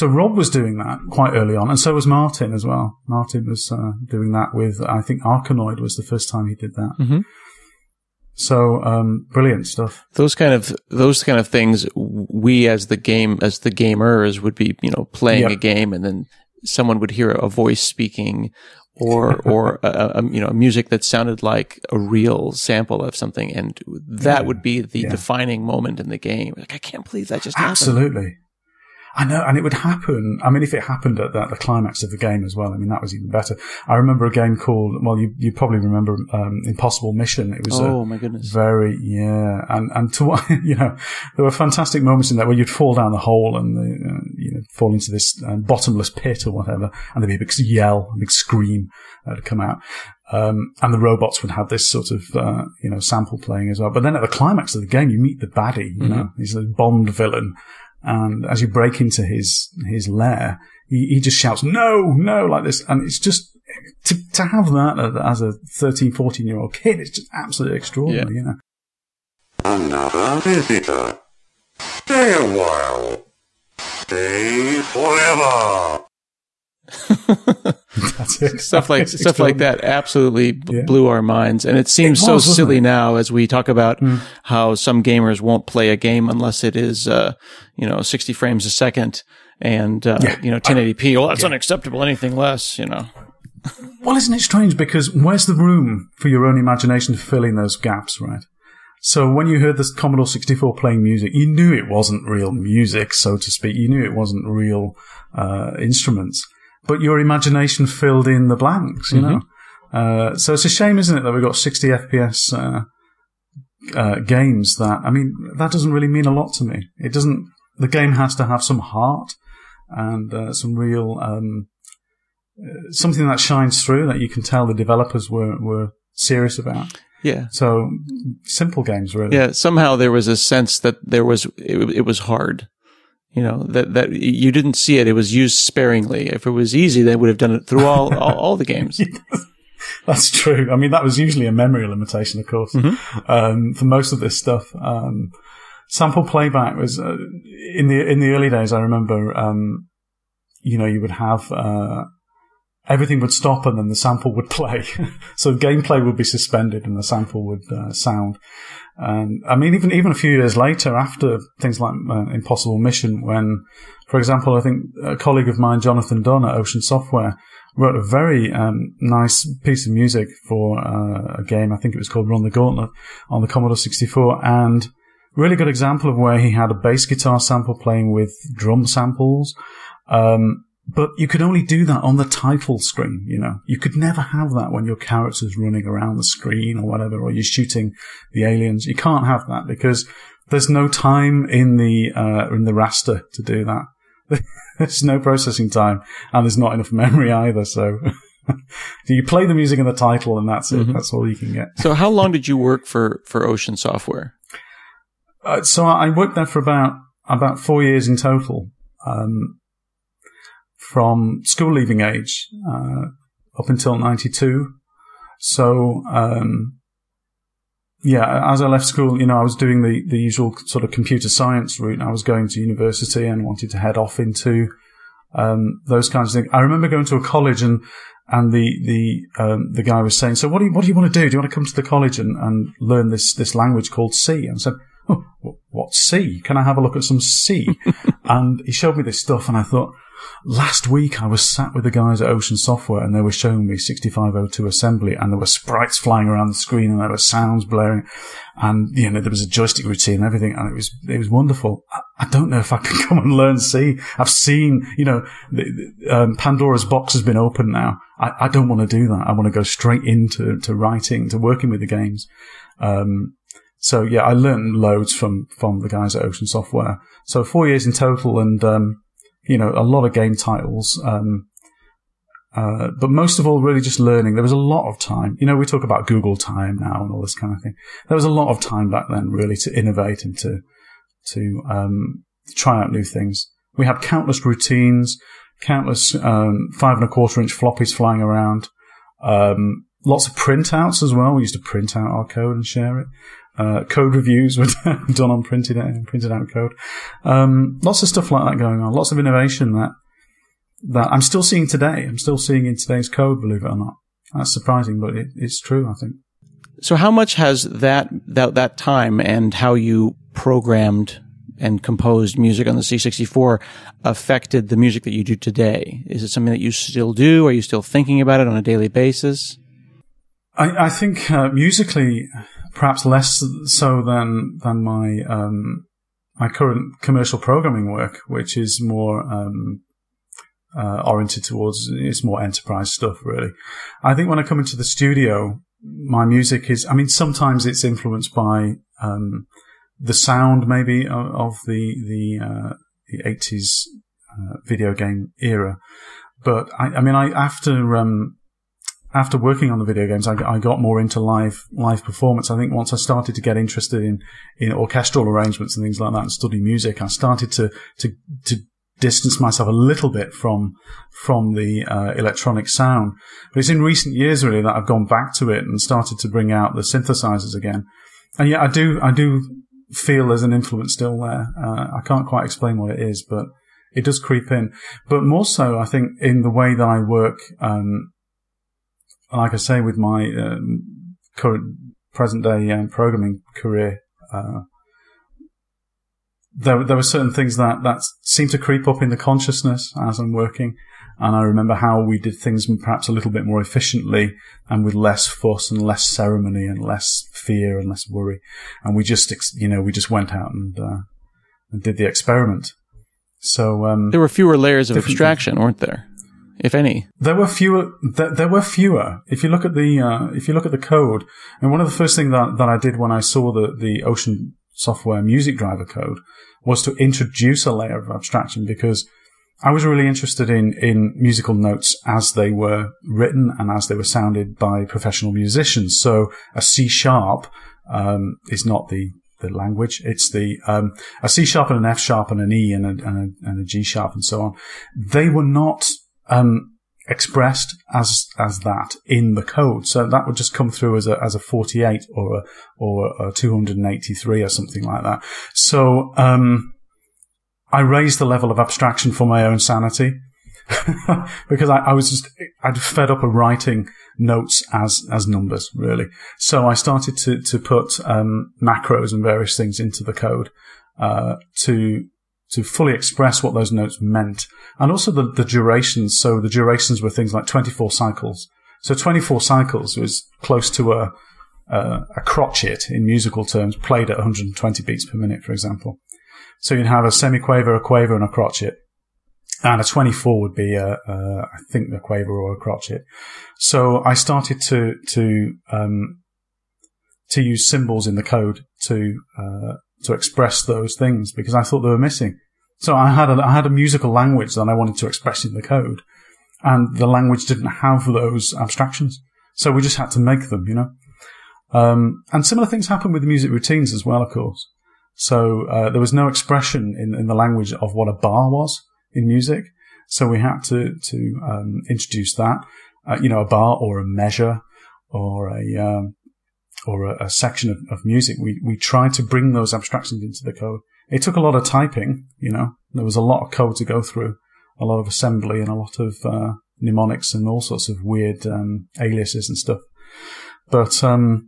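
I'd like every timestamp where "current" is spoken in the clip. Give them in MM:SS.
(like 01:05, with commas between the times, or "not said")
05:26, 06:21.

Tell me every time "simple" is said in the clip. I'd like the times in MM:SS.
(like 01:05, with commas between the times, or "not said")
02:08.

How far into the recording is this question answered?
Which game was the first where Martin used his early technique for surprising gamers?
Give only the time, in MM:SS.
00:05.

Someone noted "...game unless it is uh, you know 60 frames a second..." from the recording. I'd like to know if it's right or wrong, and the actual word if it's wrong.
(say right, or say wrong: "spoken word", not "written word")
right.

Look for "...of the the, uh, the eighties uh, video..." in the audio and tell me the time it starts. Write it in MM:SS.
05:41.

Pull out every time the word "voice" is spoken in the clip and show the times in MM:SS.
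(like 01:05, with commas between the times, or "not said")
00:17.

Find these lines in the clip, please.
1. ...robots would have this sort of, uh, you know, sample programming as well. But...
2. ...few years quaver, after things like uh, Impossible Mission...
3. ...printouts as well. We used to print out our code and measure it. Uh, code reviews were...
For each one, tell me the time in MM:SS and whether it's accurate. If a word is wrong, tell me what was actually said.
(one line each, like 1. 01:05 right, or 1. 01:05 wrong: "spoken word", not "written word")
1. 00:50 wrong: "playing", not "programming"
2. 02:40 wrong: "later", not "quaver"
3. 04:50 wrong: "share", not "measure".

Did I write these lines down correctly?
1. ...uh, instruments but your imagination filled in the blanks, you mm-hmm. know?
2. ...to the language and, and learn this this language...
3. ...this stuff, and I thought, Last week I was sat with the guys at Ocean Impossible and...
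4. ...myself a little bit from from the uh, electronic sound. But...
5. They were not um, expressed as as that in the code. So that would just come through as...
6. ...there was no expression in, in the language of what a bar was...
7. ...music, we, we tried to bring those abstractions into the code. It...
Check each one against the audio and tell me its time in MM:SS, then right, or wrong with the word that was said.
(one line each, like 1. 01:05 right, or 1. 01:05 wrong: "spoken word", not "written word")
1. 01:45 right
2. 03:51 wrong: "college", not "language"
3. 03:59 wrong: "Software", not "Impossible"
4. 05:59 right
5. 07:15 right
6. 08:25 right
7. 08:38 right.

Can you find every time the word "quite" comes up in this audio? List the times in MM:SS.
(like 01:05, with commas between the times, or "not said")
00:01, 06:12.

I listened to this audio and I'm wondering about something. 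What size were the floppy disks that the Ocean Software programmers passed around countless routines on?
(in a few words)
5 and a quarter inch.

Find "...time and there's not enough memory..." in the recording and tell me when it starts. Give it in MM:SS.
03:15.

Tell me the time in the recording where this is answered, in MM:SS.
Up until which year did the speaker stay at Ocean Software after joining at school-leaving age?
03:33.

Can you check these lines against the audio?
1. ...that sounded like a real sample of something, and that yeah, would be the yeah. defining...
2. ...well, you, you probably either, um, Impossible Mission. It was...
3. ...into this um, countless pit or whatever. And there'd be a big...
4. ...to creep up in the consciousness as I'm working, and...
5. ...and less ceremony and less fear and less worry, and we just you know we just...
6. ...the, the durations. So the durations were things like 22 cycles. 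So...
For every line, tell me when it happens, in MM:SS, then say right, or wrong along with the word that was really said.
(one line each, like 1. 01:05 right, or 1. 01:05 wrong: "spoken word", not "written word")
1. 00:20 right
2. 00:35 wrong: "remember", not "either"
3. 00:44 wrong: "bottomless", not "countless"
4. 06:28 right
5. 06:35 right
6. 07:45 wrong: "24", not "22".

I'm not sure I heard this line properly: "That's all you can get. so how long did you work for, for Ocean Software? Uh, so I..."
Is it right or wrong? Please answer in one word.
right.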